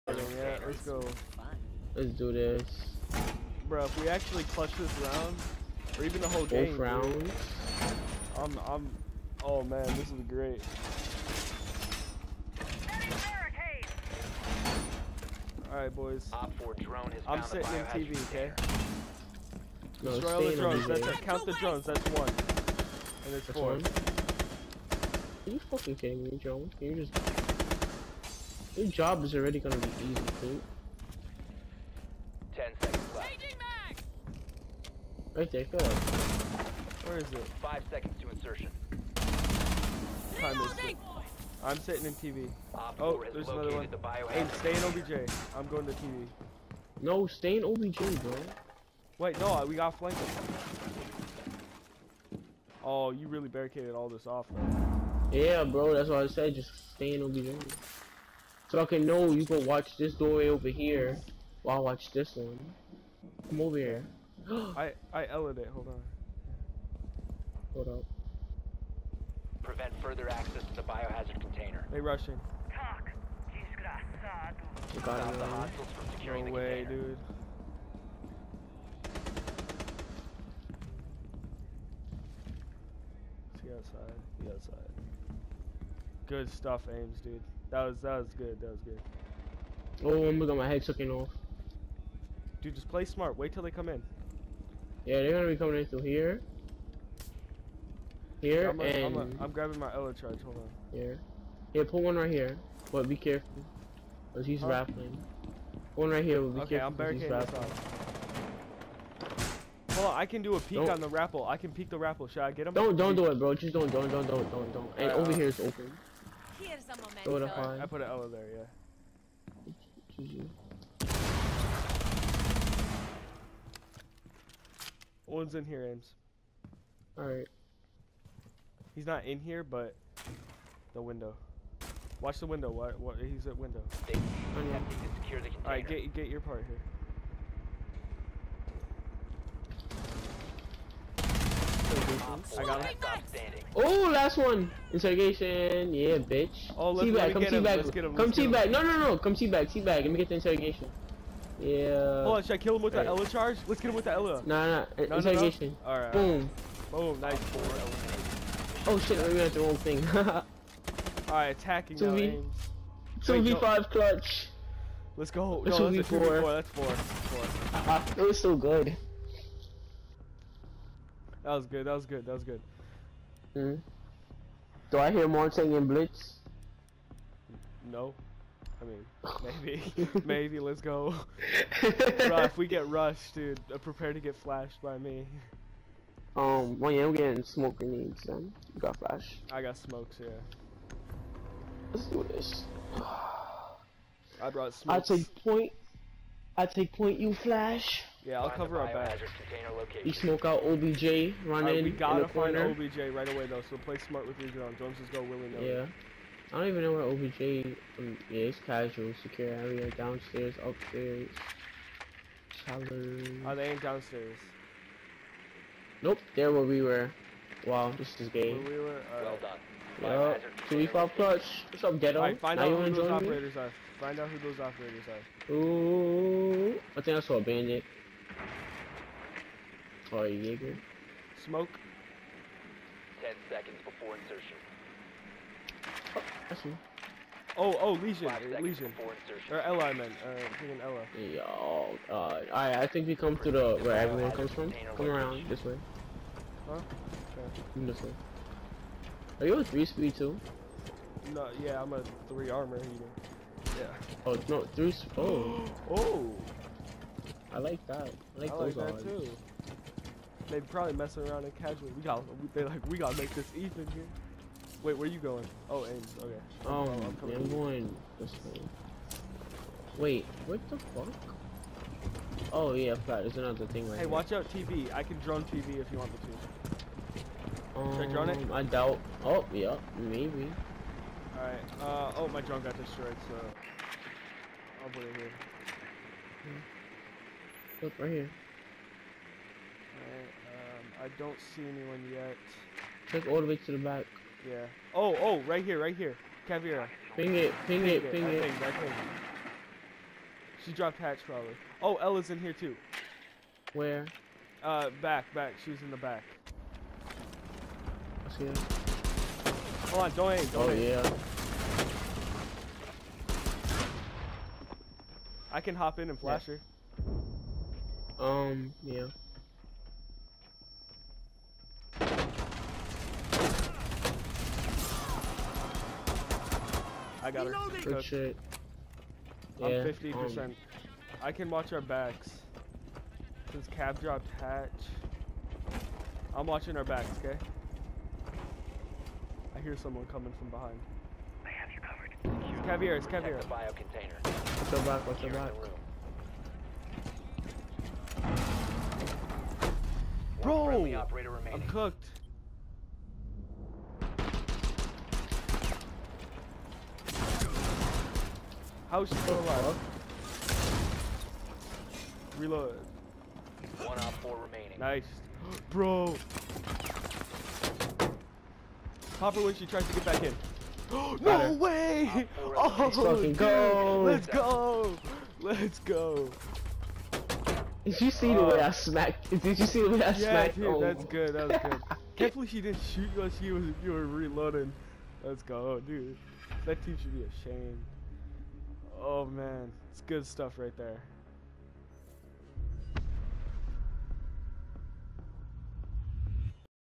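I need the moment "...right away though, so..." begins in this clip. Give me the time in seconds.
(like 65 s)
203 s.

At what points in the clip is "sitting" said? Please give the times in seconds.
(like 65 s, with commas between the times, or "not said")
17 s, 41 s.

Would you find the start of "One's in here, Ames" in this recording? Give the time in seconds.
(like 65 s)
125 s.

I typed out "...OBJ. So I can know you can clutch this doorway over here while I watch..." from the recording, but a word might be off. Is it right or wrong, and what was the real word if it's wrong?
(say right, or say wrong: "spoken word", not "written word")
wrong: "watch", not "clutch".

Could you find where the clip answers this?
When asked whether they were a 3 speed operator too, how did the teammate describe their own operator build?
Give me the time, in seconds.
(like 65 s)
252 s.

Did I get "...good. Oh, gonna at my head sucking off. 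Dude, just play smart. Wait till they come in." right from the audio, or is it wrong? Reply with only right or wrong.
right.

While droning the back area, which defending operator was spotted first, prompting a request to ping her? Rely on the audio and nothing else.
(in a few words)
Caveira.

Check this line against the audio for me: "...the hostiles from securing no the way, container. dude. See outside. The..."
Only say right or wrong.
right.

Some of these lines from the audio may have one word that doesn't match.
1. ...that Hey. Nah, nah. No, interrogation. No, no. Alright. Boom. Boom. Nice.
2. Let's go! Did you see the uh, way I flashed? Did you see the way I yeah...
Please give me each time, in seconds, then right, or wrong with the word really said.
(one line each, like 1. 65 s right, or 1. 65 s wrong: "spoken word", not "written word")
1. 154 s wrong: "Ella", not "Hey"
2. 375 s wrong: "smacked", not "flashed".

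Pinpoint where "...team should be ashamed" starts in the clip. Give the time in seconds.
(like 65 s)
386 s.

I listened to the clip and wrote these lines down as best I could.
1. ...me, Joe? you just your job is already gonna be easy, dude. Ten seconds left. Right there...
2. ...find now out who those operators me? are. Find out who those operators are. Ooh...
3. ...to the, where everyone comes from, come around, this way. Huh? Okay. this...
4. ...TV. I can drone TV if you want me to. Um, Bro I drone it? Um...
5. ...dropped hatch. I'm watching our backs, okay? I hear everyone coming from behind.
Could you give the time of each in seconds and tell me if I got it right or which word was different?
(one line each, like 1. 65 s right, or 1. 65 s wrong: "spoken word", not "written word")
1. 26 s right
2. 222 s right
3. 243 s right
4. 274 s wrong: "Should", not "Bro"
5. 333 s wrong: "someone", not "everyone".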